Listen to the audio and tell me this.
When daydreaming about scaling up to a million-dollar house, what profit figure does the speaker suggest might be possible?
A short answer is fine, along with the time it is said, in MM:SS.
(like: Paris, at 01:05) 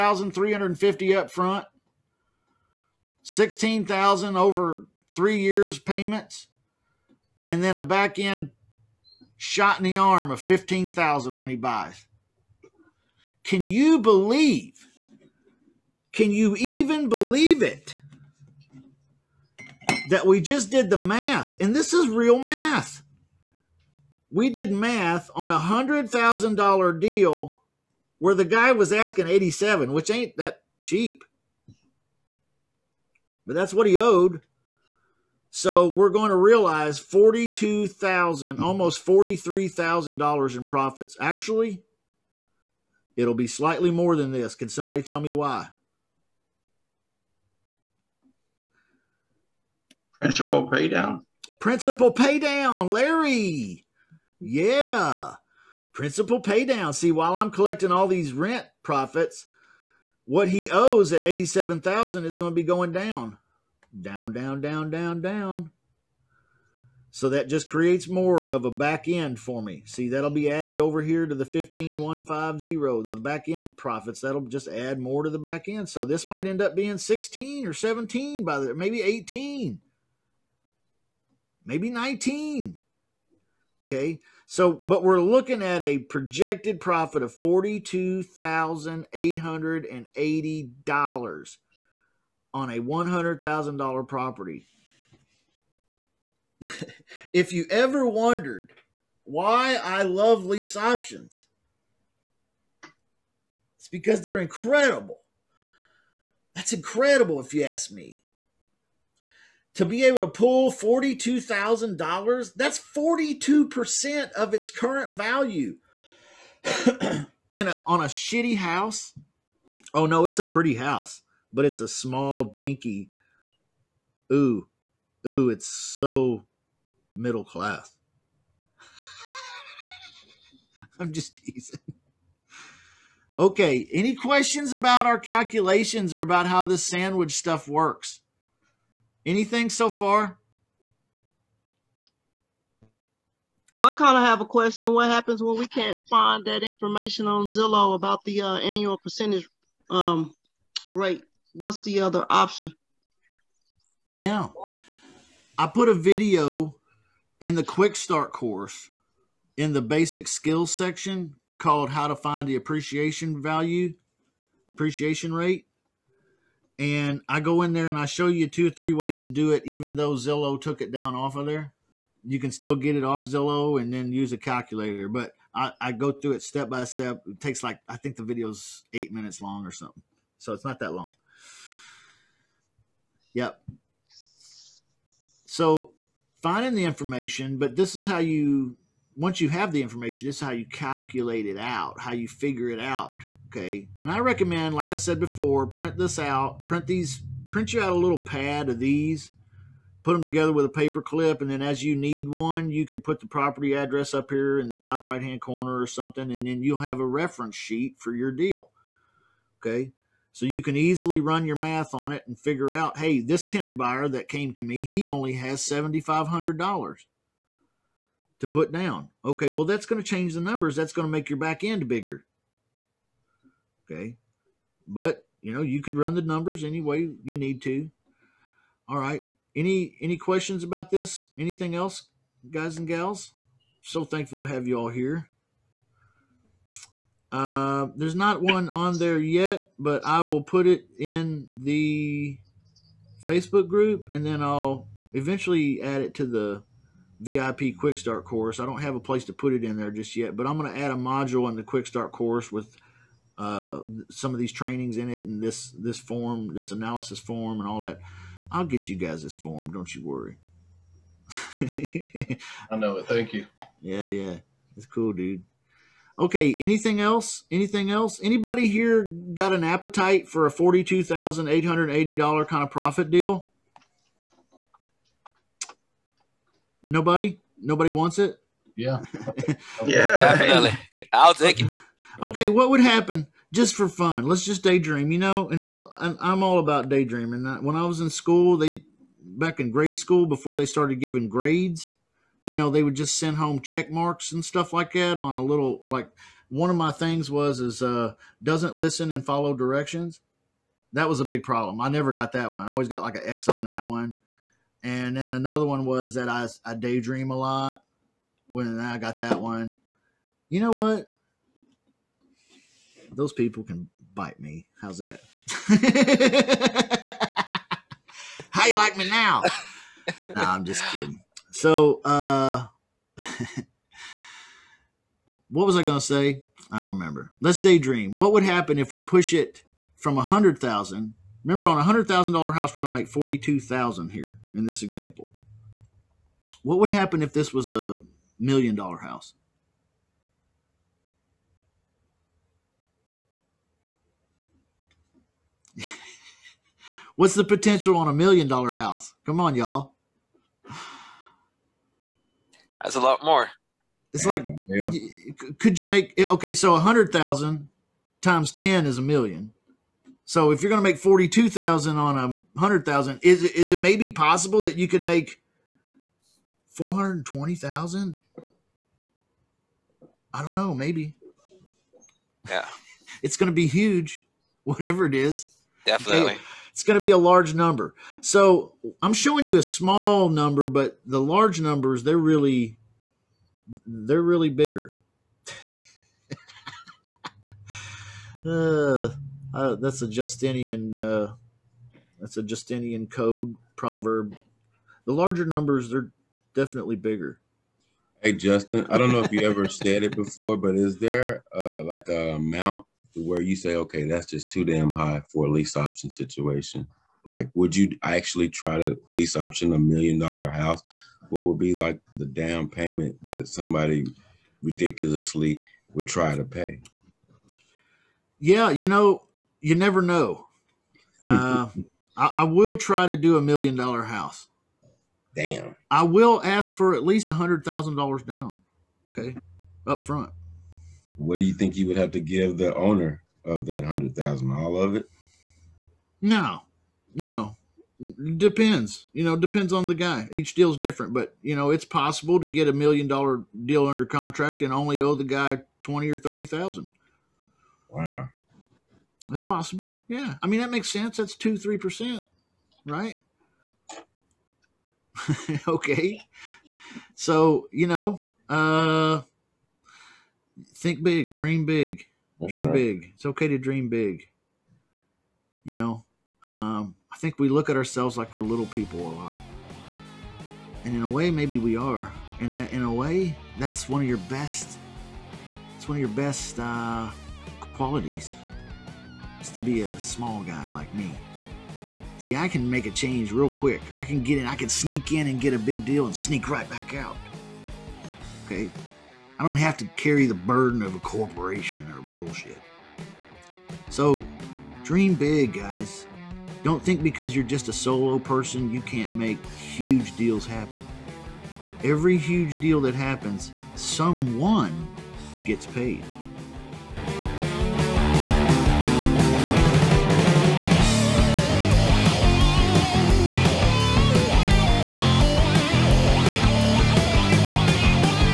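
$420,000, at 06:06.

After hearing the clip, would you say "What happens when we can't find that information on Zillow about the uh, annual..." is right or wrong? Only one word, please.
right.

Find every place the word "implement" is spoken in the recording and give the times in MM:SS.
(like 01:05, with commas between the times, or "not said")
not said.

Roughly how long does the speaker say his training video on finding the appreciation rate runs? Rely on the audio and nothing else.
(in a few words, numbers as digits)
8 minutes.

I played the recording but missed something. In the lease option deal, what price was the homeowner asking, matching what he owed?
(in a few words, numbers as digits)
87.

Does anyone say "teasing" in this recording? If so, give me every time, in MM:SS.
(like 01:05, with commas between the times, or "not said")
02:11.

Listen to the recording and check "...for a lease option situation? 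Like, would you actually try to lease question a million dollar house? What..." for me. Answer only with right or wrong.
wrong.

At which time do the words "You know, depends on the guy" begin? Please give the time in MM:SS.
07:19.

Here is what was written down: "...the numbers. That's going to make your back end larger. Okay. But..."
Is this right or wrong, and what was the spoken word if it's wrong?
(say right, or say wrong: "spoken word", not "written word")
wrong: "bigger", not "larger".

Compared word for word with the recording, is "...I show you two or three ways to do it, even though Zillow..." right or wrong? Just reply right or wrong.
right.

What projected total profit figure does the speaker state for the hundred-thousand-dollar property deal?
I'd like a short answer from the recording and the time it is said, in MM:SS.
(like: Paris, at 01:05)
$42,880, at 01:27.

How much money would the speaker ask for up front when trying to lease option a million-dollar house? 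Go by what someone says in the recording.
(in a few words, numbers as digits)
$100,000.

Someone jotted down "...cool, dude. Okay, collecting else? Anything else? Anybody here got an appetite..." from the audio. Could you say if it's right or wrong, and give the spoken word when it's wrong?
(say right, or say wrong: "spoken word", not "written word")
wrong: "anything", not "collecting".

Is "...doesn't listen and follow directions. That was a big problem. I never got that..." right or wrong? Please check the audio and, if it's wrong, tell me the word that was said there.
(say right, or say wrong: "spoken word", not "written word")
right.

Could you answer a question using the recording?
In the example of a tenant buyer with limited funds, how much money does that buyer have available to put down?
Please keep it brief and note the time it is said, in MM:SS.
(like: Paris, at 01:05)
$7,500, at 03:35.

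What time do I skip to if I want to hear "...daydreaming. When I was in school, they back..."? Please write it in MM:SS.
04:46.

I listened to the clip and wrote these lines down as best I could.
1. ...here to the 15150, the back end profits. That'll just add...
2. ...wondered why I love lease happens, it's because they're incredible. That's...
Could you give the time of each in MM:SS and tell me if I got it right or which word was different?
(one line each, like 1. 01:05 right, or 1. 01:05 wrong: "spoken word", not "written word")
1. 01:11 right
2. 01:38 wrong: "options", not "happens".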